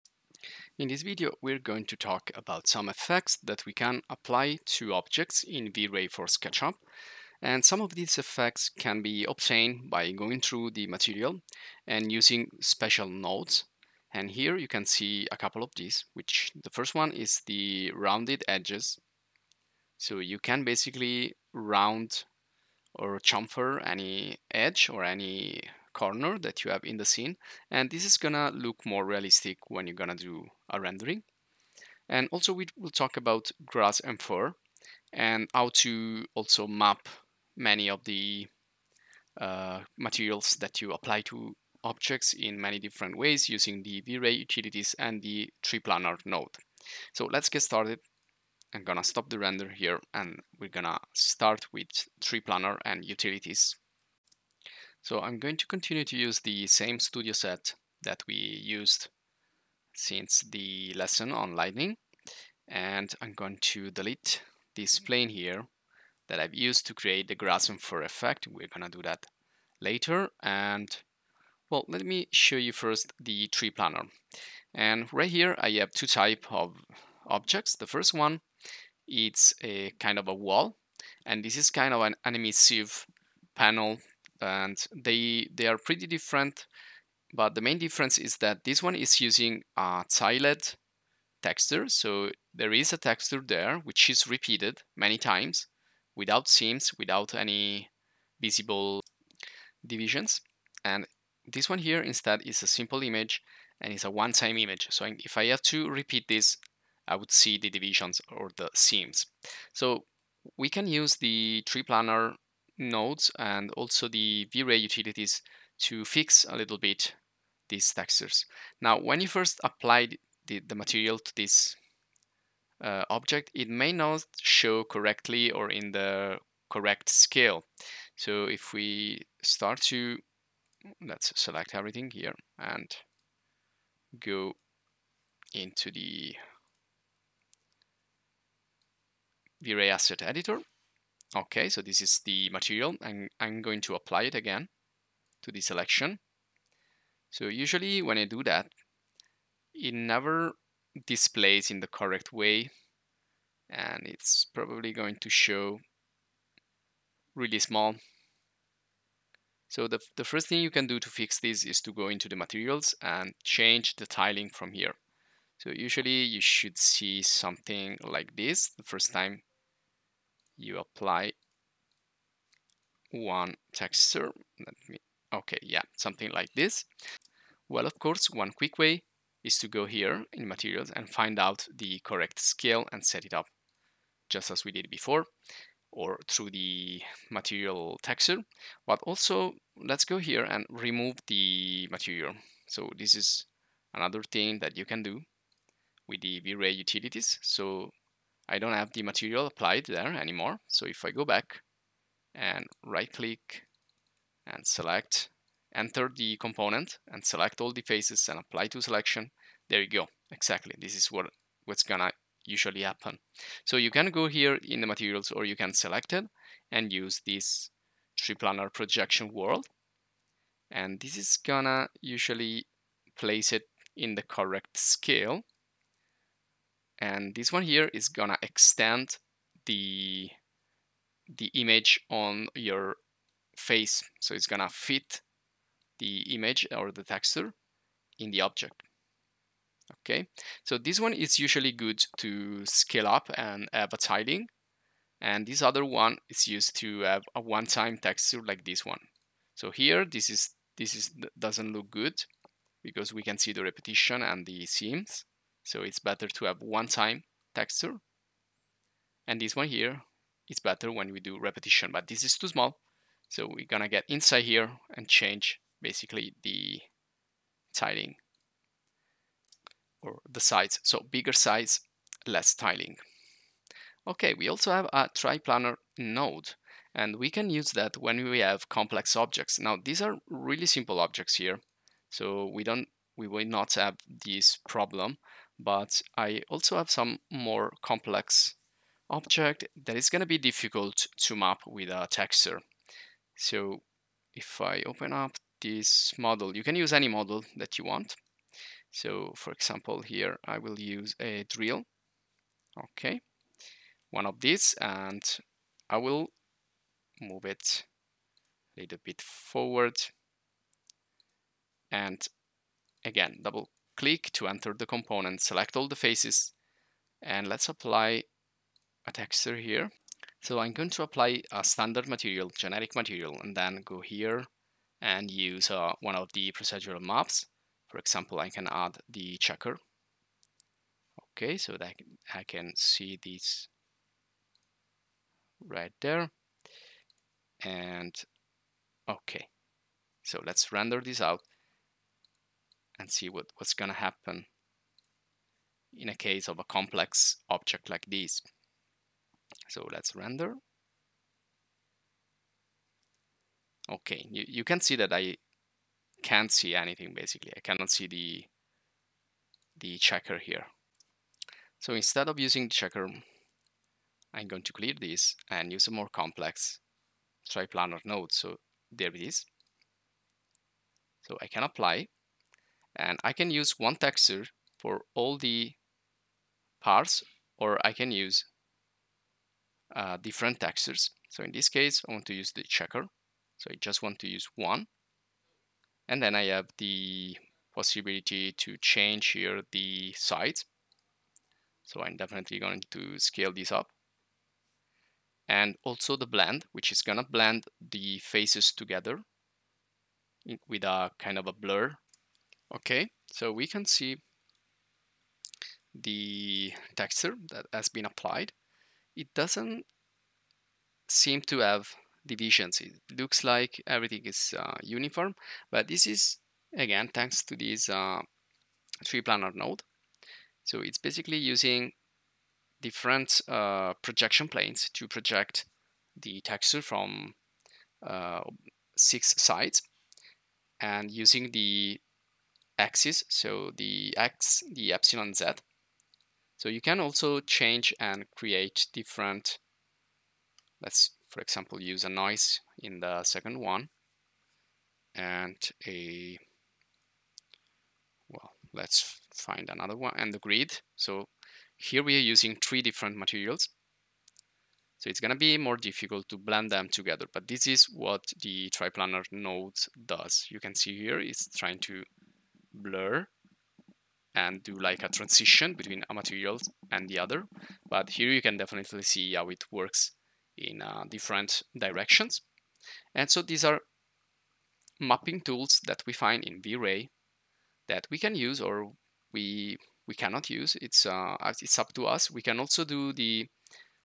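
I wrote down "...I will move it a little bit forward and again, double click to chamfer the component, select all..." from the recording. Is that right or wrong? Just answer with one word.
wrong.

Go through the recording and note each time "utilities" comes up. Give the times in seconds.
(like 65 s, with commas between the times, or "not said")
44 s, 53 s, 114 s, 196 s.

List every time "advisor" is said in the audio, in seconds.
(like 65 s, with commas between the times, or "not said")
not said.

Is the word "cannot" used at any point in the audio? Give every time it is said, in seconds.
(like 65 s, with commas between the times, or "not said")
357 s, 480 s.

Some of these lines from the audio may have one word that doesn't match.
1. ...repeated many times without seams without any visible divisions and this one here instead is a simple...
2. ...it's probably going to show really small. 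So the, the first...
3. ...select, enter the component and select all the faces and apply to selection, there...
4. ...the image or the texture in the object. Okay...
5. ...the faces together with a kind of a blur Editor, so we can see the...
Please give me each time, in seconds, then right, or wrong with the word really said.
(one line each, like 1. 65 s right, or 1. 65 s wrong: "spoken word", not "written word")
1. 94 s right
2. 154 s right
3. 204 s right
4. 235 s right
5. 397 s wrong: "Okay", not "Editor".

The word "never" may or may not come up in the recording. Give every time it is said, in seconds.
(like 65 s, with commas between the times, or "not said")
149 s.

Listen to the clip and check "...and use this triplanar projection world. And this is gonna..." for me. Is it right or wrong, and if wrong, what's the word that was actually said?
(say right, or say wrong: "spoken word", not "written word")
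right.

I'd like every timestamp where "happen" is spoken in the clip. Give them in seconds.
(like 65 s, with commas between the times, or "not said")
212 s, 343 s.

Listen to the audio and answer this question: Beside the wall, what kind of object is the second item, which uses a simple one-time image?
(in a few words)
emissive panel.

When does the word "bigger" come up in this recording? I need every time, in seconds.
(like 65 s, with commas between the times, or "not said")
271 s.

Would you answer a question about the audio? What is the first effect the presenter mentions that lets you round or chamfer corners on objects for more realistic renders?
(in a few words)
rounded edges.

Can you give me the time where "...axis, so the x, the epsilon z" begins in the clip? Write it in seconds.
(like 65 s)
432 s.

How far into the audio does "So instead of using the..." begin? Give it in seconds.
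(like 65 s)
361 s.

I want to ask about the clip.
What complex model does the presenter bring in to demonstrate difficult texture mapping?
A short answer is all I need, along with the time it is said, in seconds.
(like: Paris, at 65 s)
a drill, at 301 s.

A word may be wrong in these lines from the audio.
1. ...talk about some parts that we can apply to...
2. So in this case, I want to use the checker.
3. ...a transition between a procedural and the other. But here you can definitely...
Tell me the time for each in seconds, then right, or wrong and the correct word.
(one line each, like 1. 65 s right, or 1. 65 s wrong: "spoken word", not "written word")
1. 1 s wrong: "effects", not "parts"
2. 381 s right
3. 465 s wrong: "material", not "procedural".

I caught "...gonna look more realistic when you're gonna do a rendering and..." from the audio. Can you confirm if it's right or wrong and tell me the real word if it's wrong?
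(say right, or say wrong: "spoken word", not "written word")
right.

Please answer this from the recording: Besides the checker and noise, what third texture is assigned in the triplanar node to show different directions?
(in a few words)
grid.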